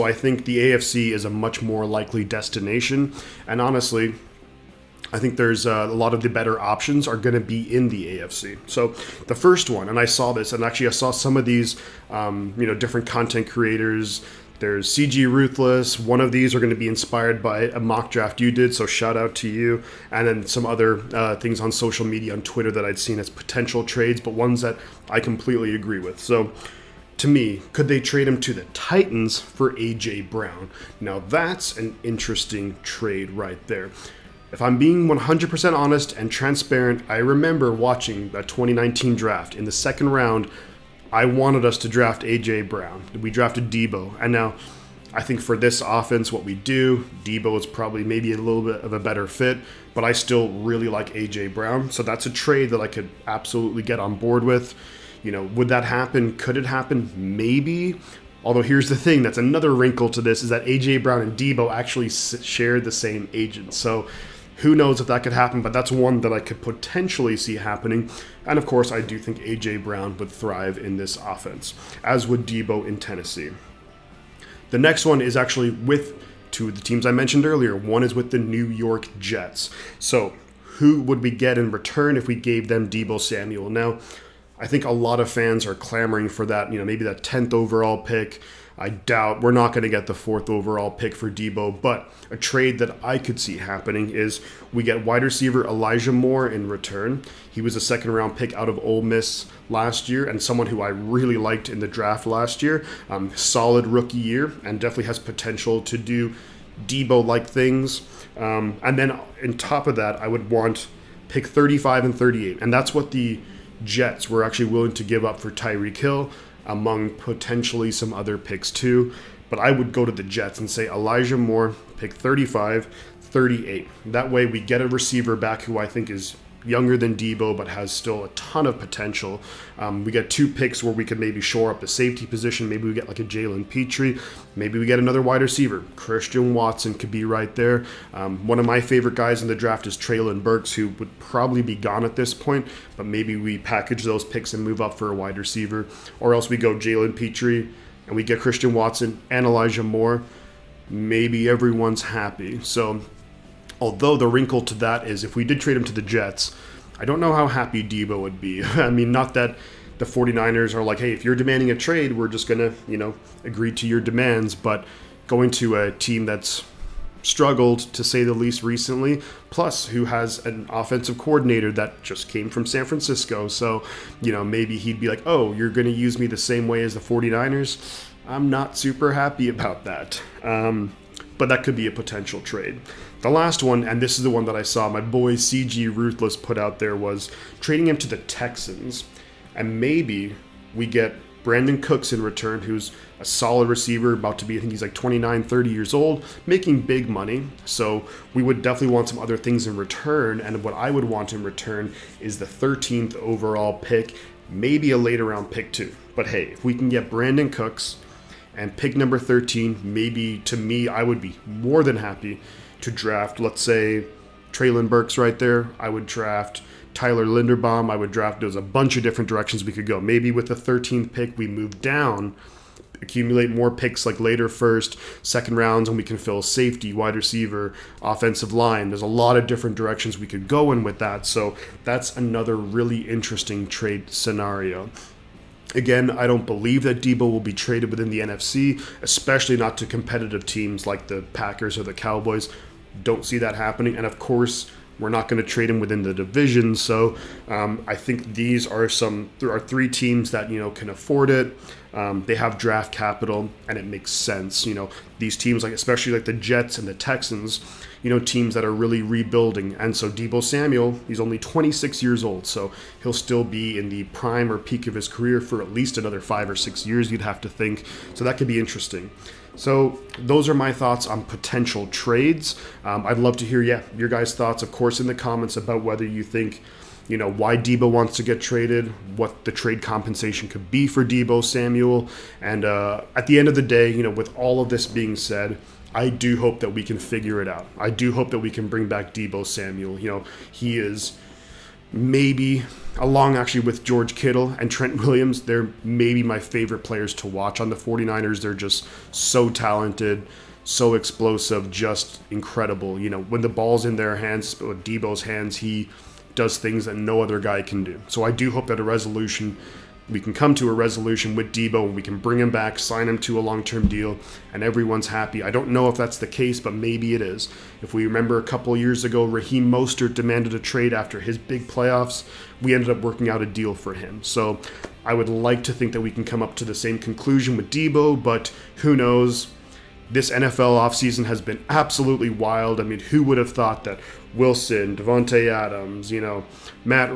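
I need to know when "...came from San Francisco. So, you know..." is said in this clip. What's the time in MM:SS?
02:52.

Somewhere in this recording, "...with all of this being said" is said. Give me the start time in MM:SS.
04:44.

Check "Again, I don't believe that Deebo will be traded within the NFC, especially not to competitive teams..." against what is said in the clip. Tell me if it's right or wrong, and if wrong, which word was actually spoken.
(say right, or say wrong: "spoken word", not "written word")
right.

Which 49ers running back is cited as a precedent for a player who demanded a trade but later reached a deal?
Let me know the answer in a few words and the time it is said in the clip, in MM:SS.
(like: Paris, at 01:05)
Raheem Mostert, at 05:19.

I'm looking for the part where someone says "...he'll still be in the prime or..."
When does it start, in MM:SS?
04:23.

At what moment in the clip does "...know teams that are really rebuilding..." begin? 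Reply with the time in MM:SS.
04:18.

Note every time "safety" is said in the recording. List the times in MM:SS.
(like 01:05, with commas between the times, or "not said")
02:11, 03:46.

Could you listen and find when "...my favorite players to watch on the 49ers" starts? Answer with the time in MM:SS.
04:56.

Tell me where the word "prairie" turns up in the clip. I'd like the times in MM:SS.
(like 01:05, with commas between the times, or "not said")
not said.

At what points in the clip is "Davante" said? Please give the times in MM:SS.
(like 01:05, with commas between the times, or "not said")
05:34.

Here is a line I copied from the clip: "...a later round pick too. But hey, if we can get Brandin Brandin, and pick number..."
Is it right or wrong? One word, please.
wrong.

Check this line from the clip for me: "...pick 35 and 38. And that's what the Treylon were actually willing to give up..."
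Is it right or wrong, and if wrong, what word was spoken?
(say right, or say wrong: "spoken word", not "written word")
wrong: "Jets", not "Treylon".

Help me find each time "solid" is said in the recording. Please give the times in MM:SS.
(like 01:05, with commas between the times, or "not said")
01:43, 03:13.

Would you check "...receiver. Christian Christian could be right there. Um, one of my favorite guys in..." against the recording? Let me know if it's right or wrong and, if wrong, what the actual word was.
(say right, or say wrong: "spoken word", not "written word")
wrong: "Watson", not "Christian".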